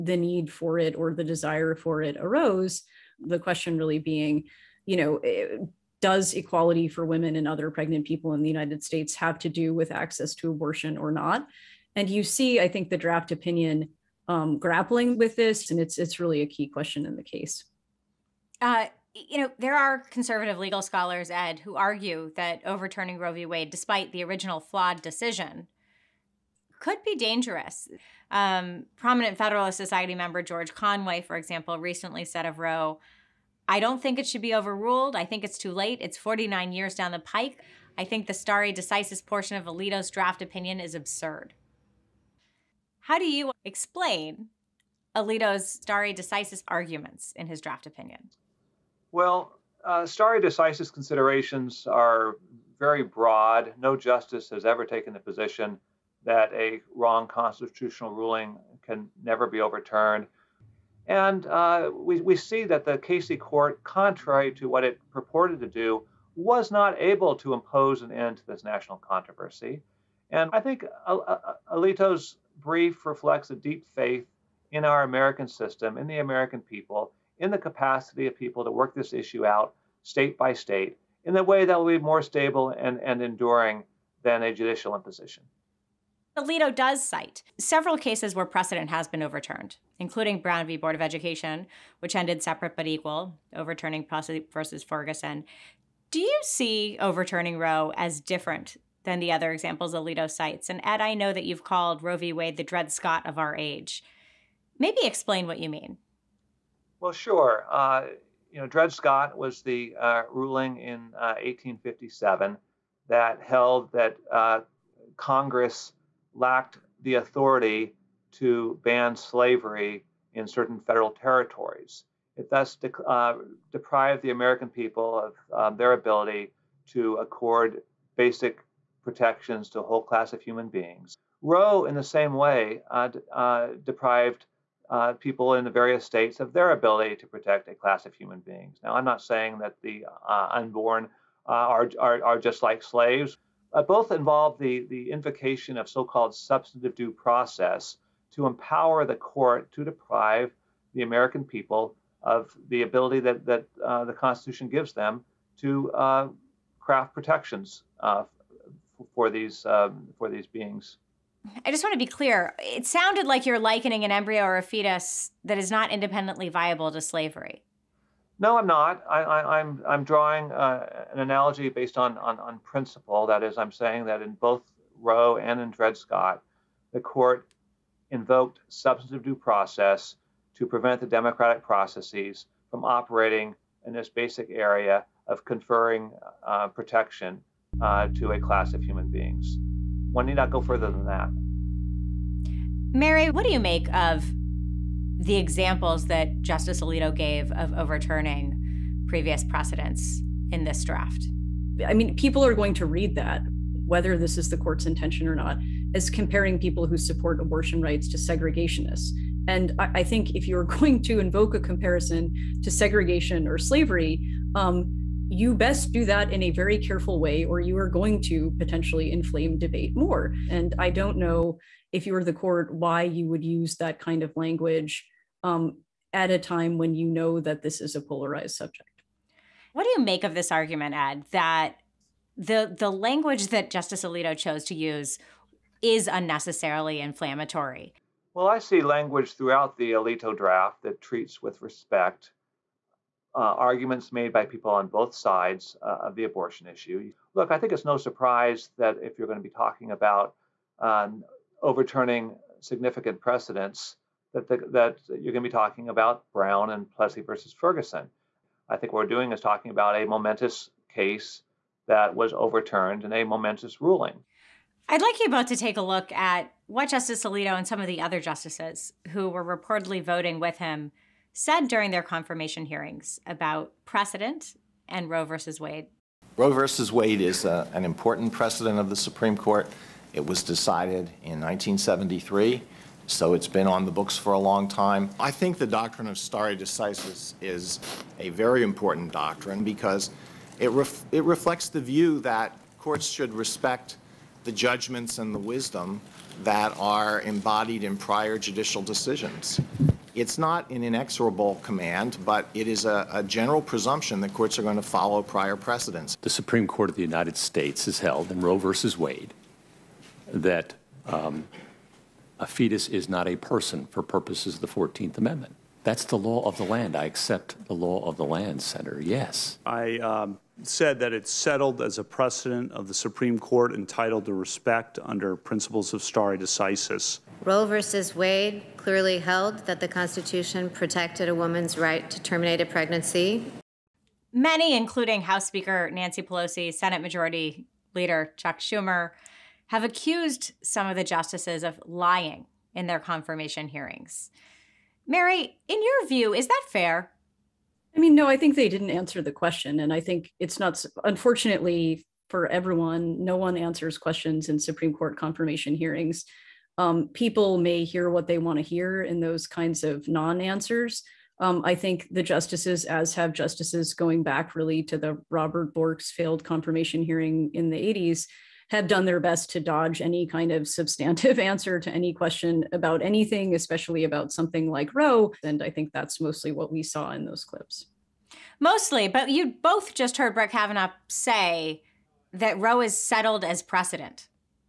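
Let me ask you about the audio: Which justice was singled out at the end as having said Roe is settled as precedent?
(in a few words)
Brett Kavanaugh.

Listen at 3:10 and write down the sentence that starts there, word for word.
One need not go further than that.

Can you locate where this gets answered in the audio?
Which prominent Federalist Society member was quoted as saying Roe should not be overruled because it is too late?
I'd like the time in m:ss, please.
0:30.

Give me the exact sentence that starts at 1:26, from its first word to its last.
Alito does cite several cases where precedent has been overturned, including Brown v.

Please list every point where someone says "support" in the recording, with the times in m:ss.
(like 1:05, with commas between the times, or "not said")
3:26.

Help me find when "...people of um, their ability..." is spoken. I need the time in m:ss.
2:04.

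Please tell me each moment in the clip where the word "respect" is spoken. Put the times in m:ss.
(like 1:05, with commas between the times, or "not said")
4:01, 4:53, 5:24.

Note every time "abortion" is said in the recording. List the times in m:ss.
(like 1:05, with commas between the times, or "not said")
0:10, 3:27, 4:06.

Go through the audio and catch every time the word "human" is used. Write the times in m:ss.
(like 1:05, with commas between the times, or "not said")
2:10, 2:18, 3:08.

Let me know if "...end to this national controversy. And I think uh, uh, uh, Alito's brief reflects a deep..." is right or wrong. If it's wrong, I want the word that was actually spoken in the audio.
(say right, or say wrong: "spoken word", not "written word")
right.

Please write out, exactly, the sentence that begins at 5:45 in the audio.
Mary, in your view, is that fair?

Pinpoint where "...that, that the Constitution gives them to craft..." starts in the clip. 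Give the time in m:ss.
2:33.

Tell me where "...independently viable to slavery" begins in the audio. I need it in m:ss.
2:45.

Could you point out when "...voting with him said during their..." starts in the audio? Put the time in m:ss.
4:30.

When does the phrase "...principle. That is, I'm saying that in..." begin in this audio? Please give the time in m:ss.
2:52.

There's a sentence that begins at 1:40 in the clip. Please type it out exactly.
And Ed, I know that you've called Roe v.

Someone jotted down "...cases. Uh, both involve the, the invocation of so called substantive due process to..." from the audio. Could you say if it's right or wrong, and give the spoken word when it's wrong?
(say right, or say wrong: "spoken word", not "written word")
wrong: "slaves", not "cases".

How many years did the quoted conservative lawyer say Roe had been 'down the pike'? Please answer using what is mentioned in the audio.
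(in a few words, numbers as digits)
49.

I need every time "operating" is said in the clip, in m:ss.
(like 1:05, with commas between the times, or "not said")
3:02.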